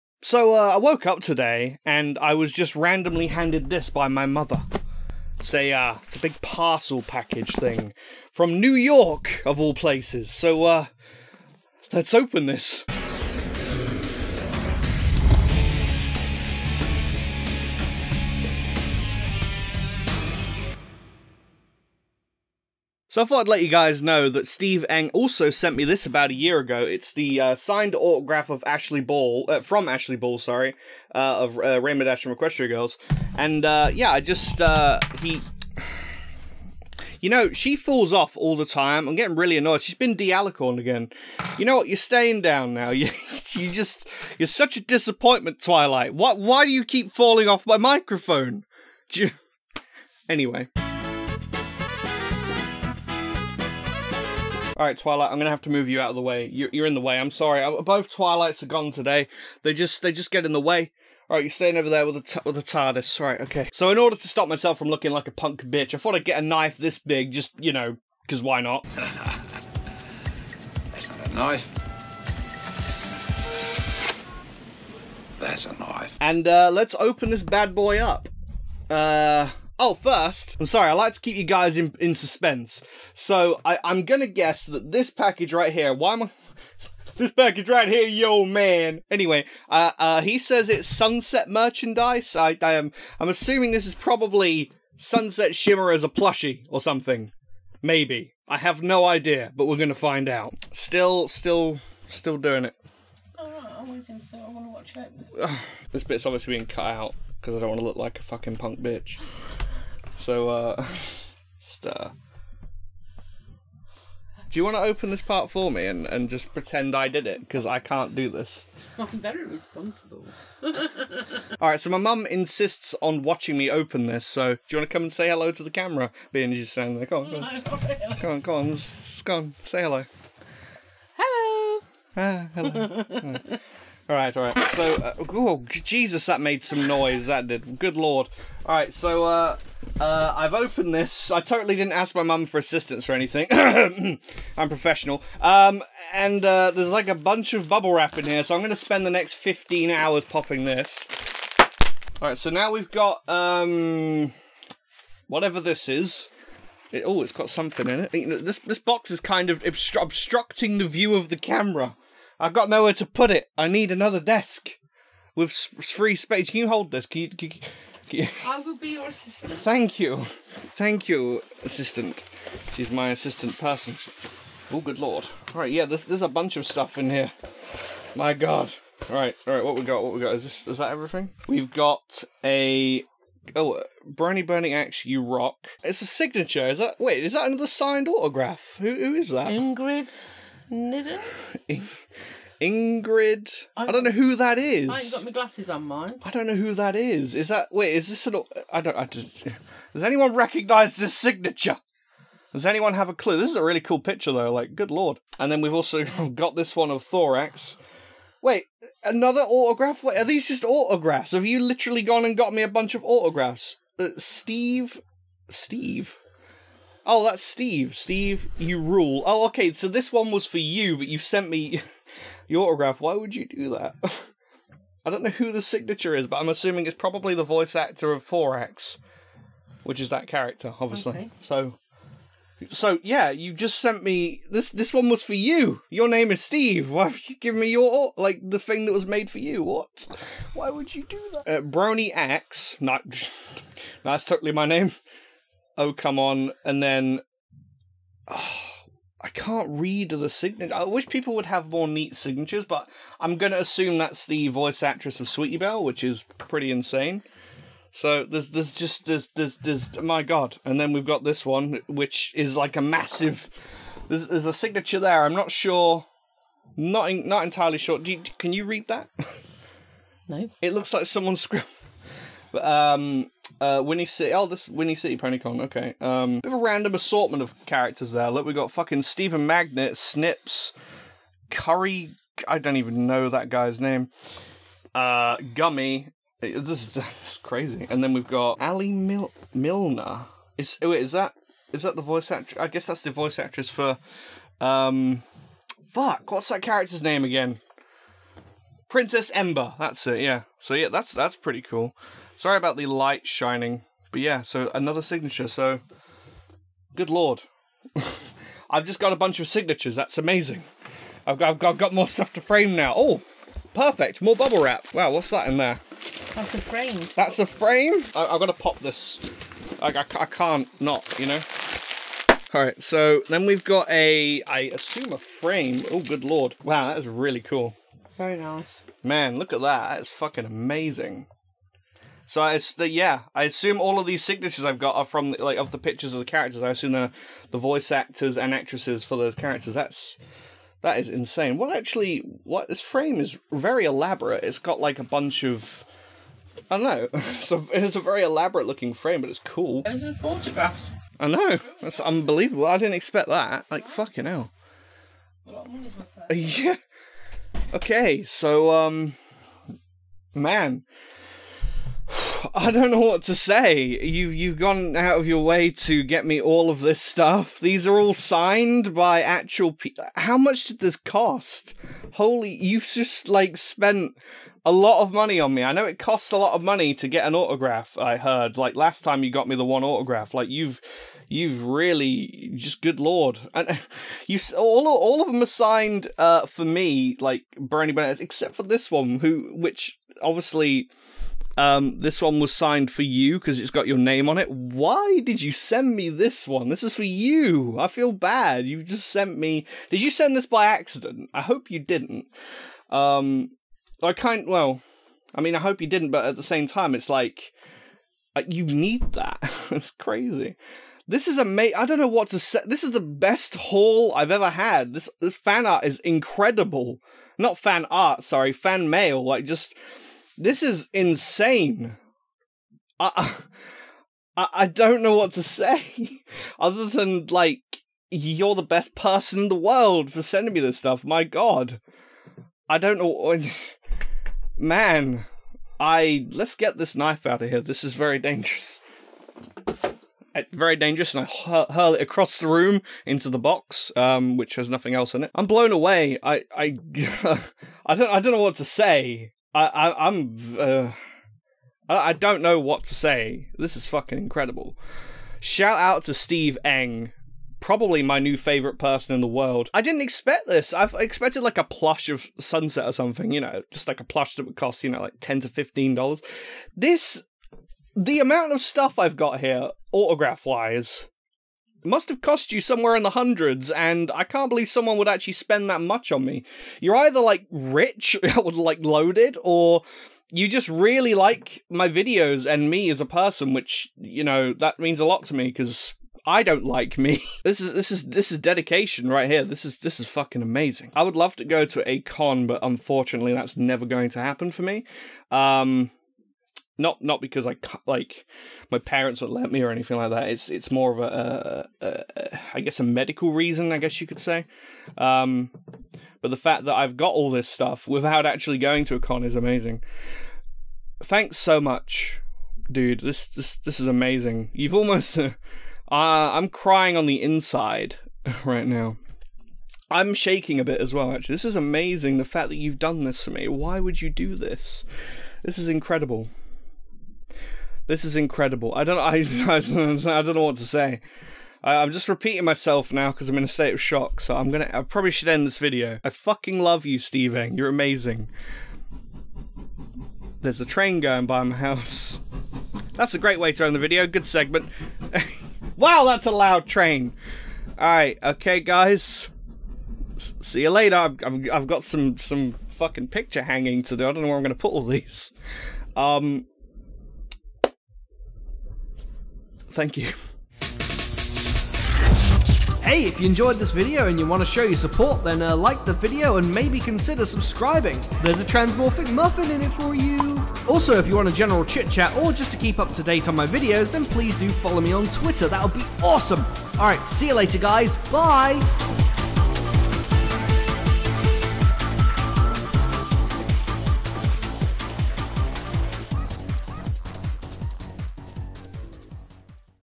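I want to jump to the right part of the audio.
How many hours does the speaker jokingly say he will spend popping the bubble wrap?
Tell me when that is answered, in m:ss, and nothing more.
2:29.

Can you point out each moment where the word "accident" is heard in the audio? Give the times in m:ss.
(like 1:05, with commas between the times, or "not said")
6:40.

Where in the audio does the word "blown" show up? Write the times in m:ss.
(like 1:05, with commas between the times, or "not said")
7:25.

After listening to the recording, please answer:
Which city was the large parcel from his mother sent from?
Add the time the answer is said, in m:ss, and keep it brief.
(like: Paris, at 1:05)
New York, at 0:08.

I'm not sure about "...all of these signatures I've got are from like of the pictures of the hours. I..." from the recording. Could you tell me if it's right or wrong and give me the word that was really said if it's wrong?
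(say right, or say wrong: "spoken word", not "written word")
wrong: "characters", not "hours".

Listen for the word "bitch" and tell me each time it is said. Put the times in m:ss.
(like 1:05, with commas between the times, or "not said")
1:05, 1:48.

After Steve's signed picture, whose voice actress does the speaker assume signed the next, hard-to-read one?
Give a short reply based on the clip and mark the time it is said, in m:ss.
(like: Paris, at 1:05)
Sweetie Belle, at 4:15.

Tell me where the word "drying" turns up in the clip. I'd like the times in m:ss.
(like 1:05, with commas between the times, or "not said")
not said.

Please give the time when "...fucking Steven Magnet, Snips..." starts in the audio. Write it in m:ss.
4:38.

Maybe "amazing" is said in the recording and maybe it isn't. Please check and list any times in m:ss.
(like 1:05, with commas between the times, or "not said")
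5:10, 5:30, 6:51, 8:10, 8:29, 8:33, 8:41, 8:57.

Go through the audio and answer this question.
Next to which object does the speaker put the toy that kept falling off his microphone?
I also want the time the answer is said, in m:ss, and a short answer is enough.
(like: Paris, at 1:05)
the TARDIS, at 1:02.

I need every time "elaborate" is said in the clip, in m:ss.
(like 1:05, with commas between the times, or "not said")
5:43, 5:48.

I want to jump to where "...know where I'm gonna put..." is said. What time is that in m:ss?
9:14.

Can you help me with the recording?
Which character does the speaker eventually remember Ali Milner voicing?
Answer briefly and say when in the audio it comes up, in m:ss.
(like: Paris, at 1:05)
Princess Ember, at 4:58.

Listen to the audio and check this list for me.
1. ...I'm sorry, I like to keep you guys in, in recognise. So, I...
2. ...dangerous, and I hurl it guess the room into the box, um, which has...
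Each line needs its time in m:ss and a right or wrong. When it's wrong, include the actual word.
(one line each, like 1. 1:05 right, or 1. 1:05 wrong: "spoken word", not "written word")
1. 1:20 wrong: "suspense", not "recognise"
2. 7:20 wrong: "across", not "guess".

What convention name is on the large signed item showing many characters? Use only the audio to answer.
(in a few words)
Whinny City Ponycon.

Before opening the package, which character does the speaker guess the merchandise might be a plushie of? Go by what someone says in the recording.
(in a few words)
Sunset Shimmer.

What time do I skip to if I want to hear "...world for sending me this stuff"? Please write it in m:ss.
7:09.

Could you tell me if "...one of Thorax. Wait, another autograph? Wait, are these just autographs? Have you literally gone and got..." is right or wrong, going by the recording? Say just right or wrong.
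right.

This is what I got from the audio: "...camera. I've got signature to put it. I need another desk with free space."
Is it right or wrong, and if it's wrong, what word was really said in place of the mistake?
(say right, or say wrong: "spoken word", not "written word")
wrong: "nowhere", not "signature".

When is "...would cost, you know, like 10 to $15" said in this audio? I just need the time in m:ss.
7:44.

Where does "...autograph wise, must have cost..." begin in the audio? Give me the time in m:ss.
7:49.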